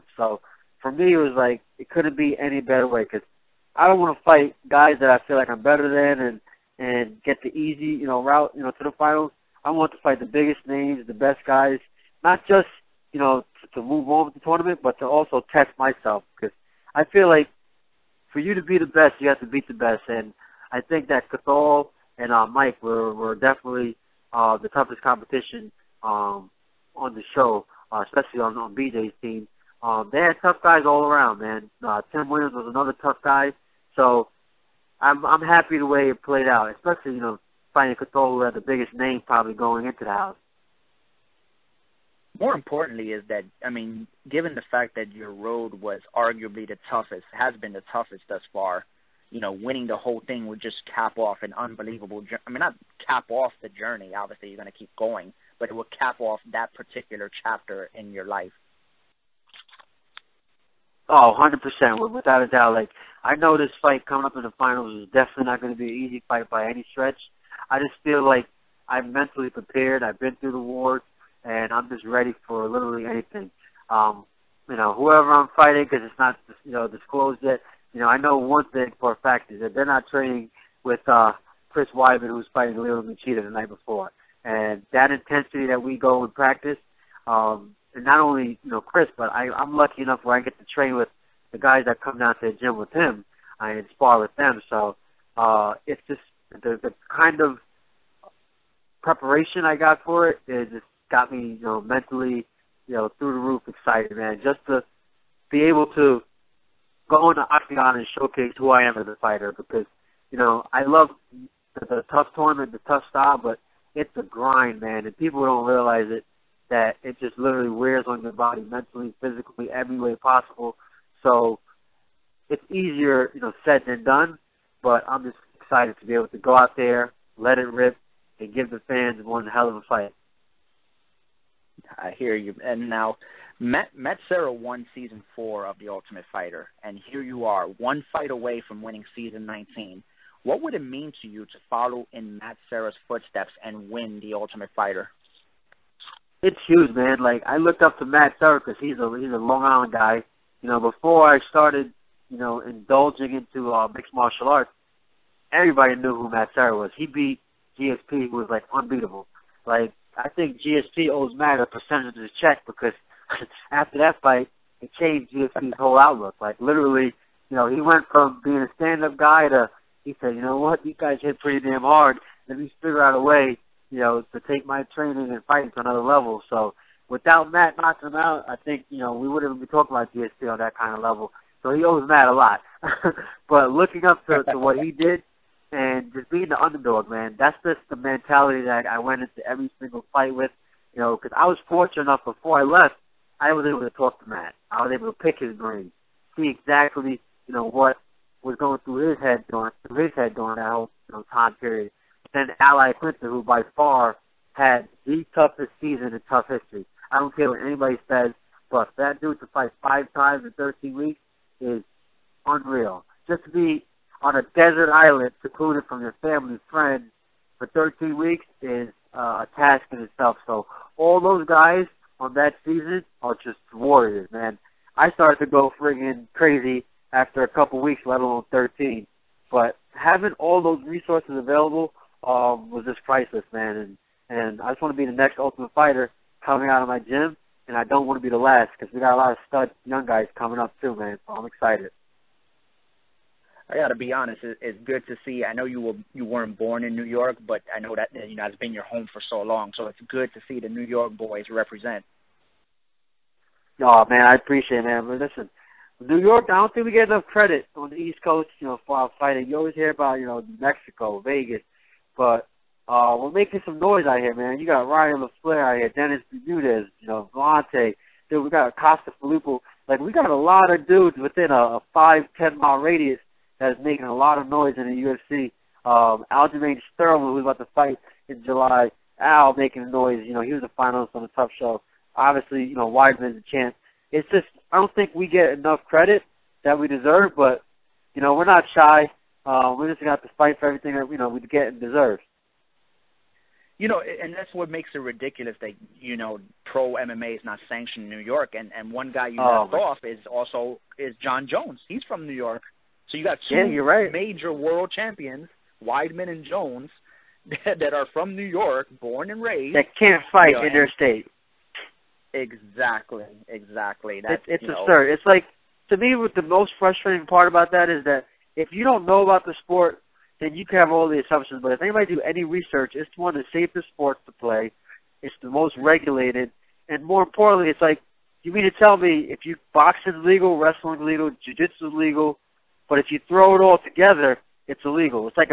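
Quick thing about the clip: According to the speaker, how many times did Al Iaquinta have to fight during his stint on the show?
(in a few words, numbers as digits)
5.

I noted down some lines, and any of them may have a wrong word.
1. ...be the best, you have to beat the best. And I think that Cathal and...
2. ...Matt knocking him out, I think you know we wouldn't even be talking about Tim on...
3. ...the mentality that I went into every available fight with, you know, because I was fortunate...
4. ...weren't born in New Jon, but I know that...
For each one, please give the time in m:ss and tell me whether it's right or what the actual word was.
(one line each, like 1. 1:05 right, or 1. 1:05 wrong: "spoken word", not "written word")
1. 0:18 right
2. 2:57 wrong: "GSP", not "Tim"
3. 3:07 wrong: "single", not "available"
4. 4:06 wrong: "York", not "Jon".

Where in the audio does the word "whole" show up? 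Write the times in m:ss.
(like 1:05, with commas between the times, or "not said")
0:49, 2:45, 3:20.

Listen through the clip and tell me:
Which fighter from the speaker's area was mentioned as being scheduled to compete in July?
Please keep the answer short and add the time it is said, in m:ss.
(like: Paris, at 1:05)
Aljamain Sterling, at 4:36.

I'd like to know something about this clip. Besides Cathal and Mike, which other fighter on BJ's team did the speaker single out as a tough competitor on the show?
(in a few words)
Tim Williams.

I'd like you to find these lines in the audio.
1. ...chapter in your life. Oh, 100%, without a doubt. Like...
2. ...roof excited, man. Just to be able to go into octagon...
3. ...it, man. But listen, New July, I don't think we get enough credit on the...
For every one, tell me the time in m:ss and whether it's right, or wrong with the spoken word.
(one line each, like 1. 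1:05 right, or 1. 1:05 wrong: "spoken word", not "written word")
1. 0:57 right
2. 1:43 right
3. 4:14 wrong: "York", not "July".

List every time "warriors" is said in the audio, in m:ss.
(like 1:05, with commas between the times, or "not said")
3:43.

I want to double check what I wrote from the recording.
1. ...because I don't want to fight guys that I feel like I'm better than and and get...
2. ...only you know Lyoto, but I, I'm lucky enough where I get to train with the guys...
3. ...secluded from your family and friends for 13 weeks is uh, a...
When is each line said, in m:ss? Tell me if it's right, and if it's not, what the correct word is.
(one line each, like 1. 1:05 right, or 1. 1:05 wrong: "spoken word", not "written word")
1. 0:03 right
2. 1:28 wrong: "Chris", not "Lyoto"
3. 3:35 right.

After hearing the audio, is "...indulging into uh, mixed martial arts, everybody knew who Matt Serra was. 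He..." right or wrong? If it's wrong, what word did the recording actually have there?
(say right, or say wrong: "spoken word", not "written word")
right.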